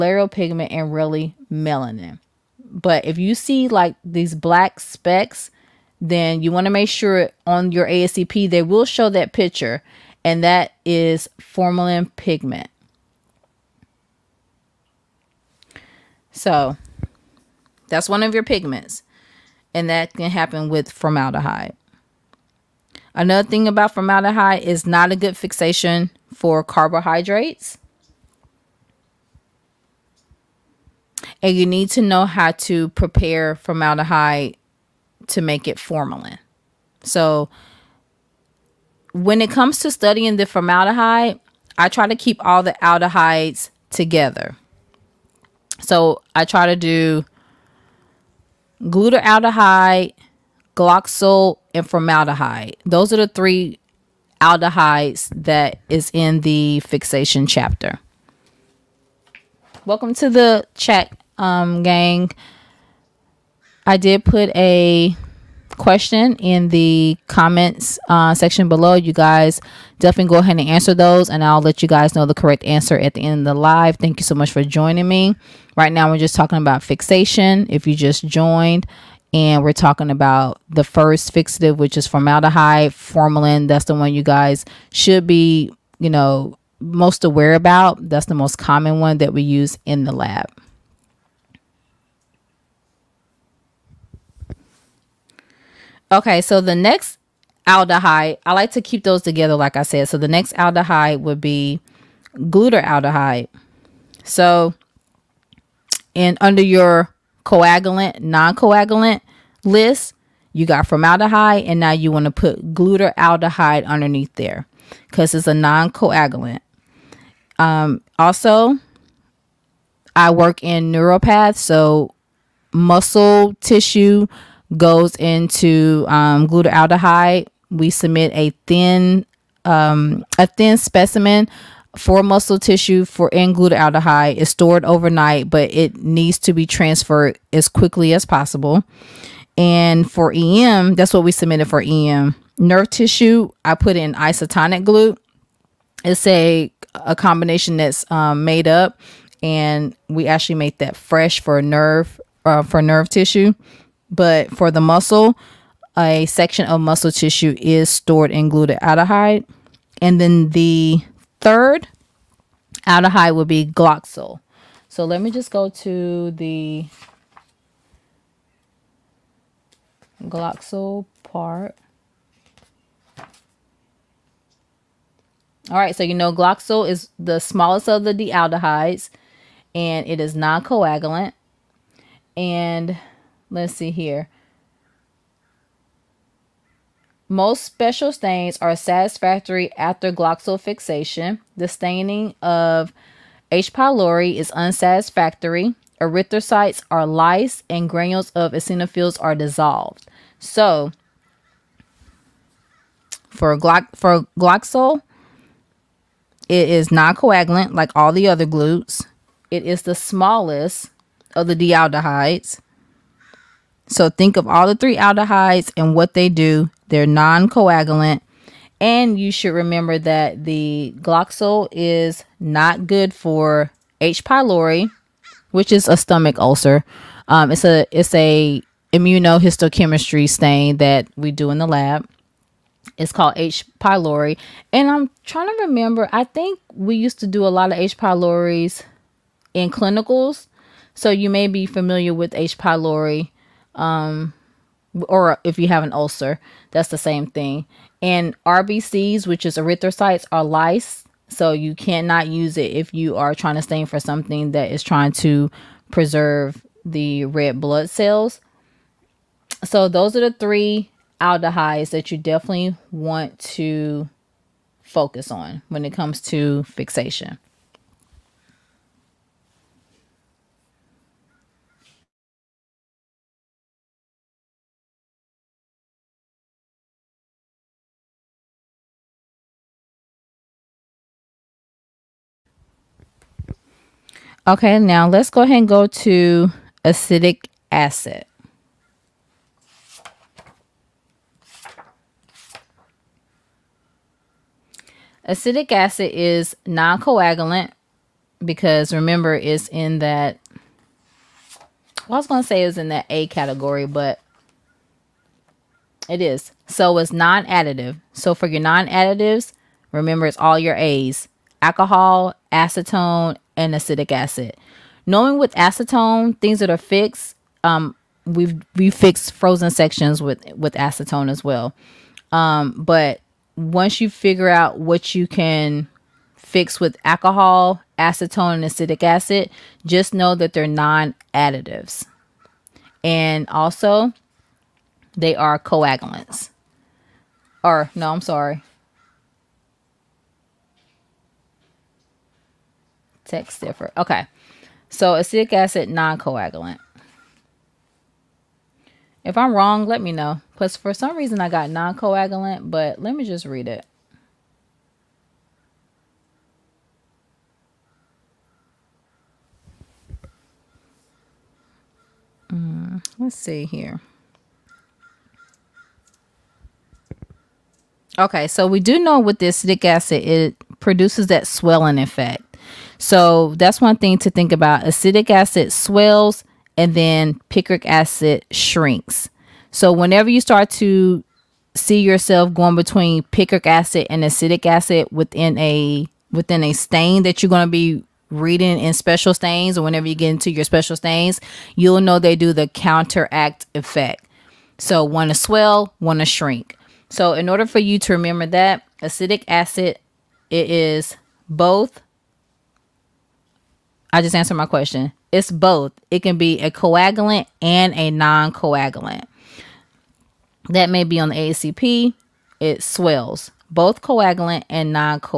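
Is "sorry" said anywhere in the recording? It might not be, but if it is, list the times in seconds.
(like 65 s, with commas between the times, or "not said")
338 s.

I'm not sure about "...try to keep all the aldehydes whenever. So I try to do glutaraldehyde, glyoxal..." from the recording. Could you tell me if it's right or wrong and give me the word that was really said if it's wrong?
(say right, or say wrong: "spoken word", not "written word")
wrong: "together", not "whenever".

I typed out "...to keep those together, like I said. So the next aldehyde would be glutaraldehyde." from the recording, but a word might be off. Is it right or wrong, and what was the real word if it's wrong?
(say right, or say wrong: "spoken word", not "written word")
right.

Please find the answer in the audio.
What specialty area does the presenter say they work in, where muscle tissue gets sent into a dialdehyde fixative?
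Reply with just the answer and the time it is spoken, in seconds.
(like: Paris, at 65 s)
Neuropath, at 120 s.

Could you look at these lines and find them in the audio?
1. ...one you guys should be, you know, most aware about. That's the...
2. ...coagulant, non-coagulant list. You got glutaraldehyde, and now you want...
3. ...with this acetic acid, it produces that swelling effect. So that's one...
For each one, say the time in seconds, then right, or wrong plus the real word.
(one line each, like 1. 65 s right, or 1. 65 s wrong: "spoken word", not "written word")
1. 83 s right
2. 107 s wrong: "formaldehyde", not "glutaraldehyde"
3. 369 s right.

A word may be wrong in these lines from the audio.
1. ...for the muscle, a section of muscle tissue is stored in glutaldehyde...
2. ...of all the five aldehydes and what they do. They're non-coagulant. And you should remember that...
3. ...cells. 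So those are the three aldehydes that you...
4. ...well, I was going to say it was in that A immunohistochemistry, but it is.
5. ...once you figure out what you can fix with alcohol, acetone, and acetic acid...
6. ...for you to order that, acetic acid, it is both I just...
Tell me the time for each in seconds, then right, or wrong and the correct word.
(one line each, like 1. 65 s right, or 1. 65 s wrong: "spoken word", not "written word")
1. 154 s right
2. 214 s wrong: "three", not "five"
3. 257 s right
4. 302 s wrong: "category", not "immunohistochemistry"
5. 323 s right
6. 397 s wrong: "remember", not "order".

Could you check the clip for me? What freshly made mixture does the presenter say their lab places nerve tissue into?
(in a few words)
Isotonic glute.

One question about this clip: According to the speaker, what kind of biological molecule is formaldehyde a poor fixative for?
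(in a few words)
Carbohydrates.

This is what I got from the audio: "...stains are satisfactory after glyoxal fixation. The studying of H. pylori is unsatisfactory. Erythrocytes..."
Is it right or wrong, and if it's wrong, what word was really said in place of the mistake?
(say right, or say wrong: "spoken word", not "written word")
wrong: "staining", not "studying".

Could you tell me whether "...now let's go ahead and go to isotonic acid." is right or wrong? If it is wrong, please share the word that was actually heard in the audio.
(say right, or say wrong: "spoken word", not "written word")
wrong: "acidic", not "isotonic".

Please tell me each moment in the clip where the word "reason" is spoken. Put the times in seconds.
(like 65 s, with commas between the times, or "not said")
351 s.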